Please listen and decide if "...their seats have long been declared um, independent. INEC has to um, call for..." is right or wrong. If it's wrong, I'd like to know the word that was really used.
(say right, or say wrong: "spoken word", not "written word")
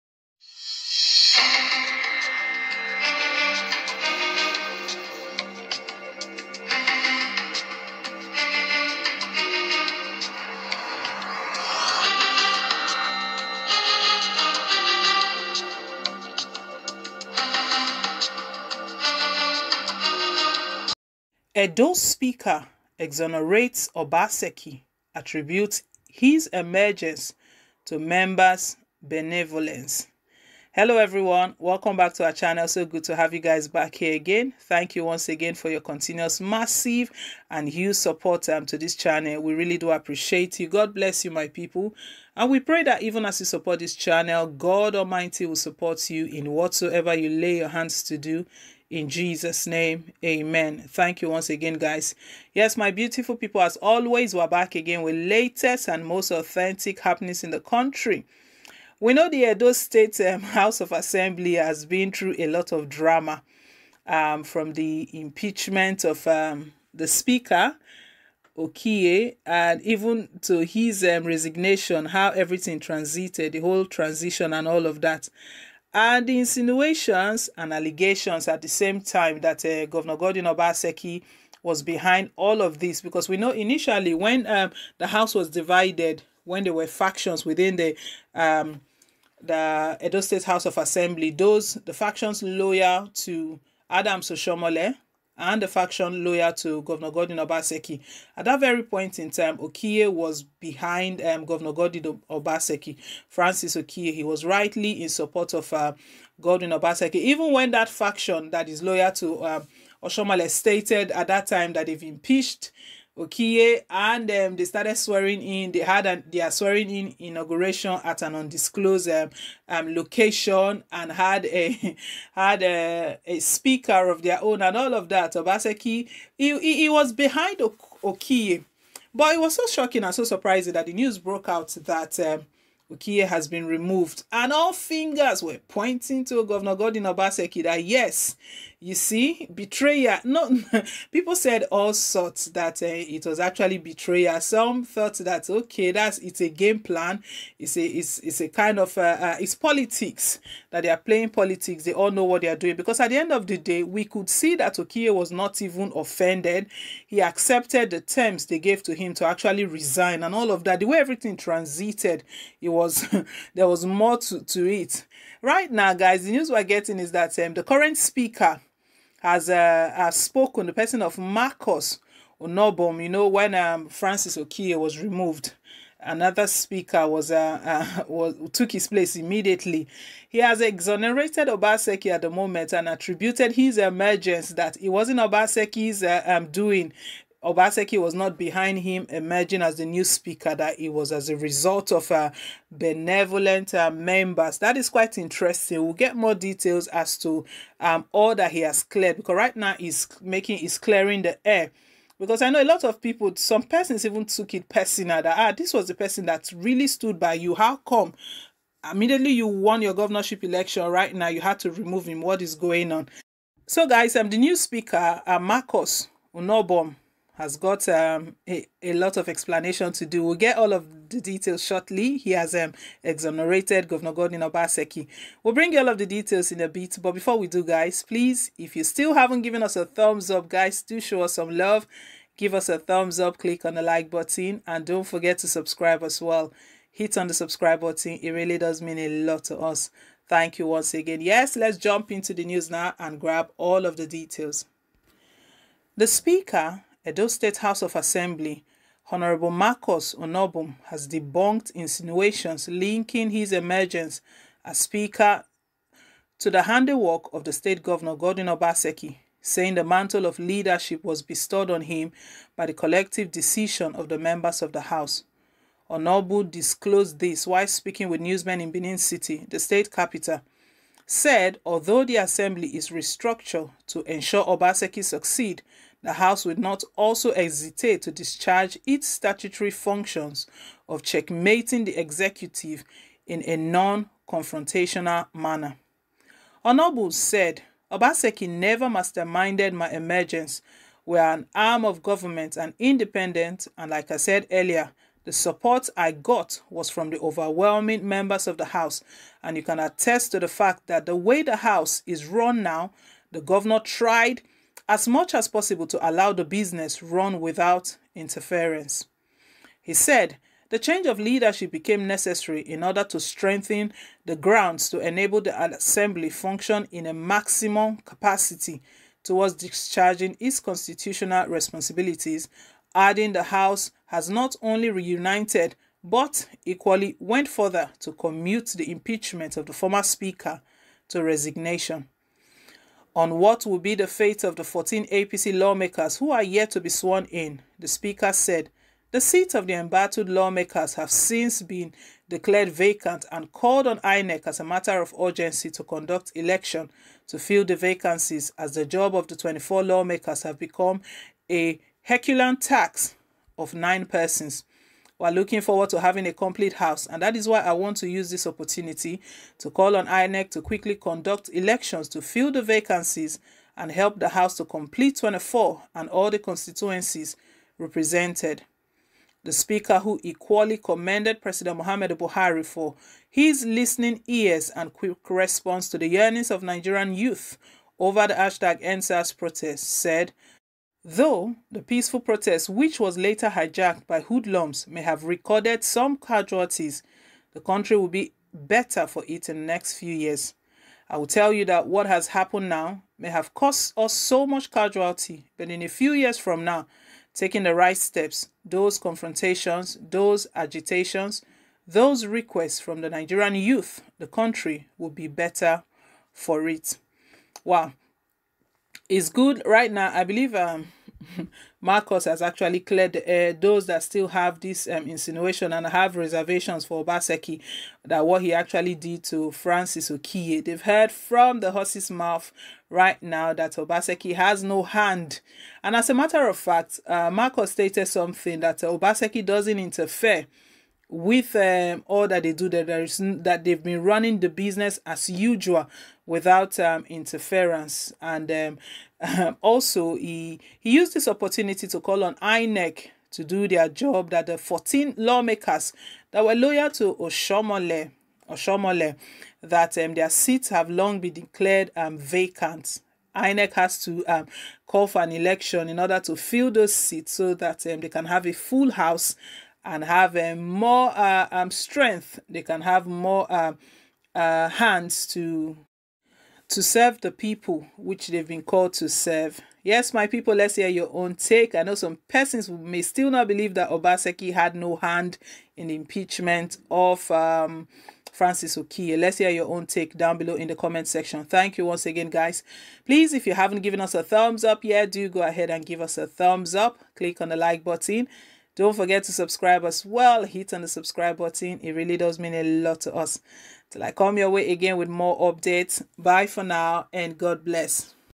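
wrong: "vacant", not "independent".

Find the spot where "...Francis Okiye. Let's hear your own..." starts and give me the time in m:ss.
7:58.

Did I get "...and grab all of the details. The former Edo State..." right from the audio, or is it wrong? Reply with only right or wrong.
wrong.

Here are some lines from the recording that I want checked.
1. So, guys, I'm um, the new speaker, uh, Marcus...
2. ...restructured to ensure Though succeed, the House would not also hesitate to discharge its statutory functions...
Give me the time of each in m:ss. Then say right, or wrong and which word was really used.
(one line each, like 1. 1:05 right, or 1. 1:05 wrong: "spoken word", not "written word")
1. 3:33 right
2. 4:32 wrong: "Obaseki", not "Though".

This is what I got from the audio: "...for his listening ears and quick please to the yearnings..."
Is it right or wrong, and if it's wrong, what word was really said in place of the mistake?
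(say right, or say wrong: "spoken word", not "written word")
wrong: "response", not "please".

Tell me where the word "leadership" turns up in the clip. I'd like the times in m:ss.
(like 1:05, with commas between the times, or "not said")
4:20, 5:11.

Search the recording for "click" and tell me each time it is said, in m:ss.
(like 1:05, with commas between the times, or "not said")
3:53, 8:07.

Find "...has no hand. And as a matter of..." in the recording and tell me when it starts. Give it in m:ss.
7:04.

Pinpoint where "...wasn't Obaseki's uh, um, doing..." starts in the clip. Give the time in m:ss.
3:04.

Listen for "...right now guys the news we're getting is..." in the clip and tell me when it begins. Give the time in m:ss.
2:45.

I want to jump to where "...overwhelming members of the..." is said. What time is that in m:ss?
4:57.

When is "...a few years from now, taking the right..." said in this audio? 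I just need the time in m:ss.
6:35.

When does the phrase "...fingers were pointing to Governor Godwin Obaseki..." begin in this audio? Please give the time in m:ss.
2:14.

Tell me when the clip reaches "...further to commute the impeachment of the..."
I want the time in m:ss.
5:27.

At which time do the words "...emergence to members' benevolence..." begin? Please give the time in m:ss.
0:26.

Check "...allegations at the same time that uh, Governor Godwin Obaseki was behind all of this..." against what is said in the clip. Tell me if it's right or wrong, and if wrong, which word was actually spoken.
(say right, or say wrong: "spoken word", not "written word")
right.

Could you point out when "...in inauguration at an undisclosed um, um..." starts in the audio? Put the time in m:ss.
1:56.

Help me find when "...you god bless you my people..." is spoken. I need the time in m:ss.
0:40.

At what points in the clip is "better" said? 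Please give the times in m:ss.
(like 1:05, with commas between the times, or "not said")
6:28, 6:45.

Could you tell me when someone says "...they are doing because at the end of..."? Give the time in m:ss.
2:32.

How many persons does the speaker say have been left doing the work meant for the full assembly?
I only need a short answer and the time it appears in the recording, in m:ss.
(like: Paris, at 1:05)
nine, at 5:53.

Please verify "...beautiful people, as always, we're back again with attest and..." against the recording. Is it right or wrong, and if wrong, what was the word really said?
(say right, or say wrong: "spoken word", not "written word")
wrong: "latest", not "attest".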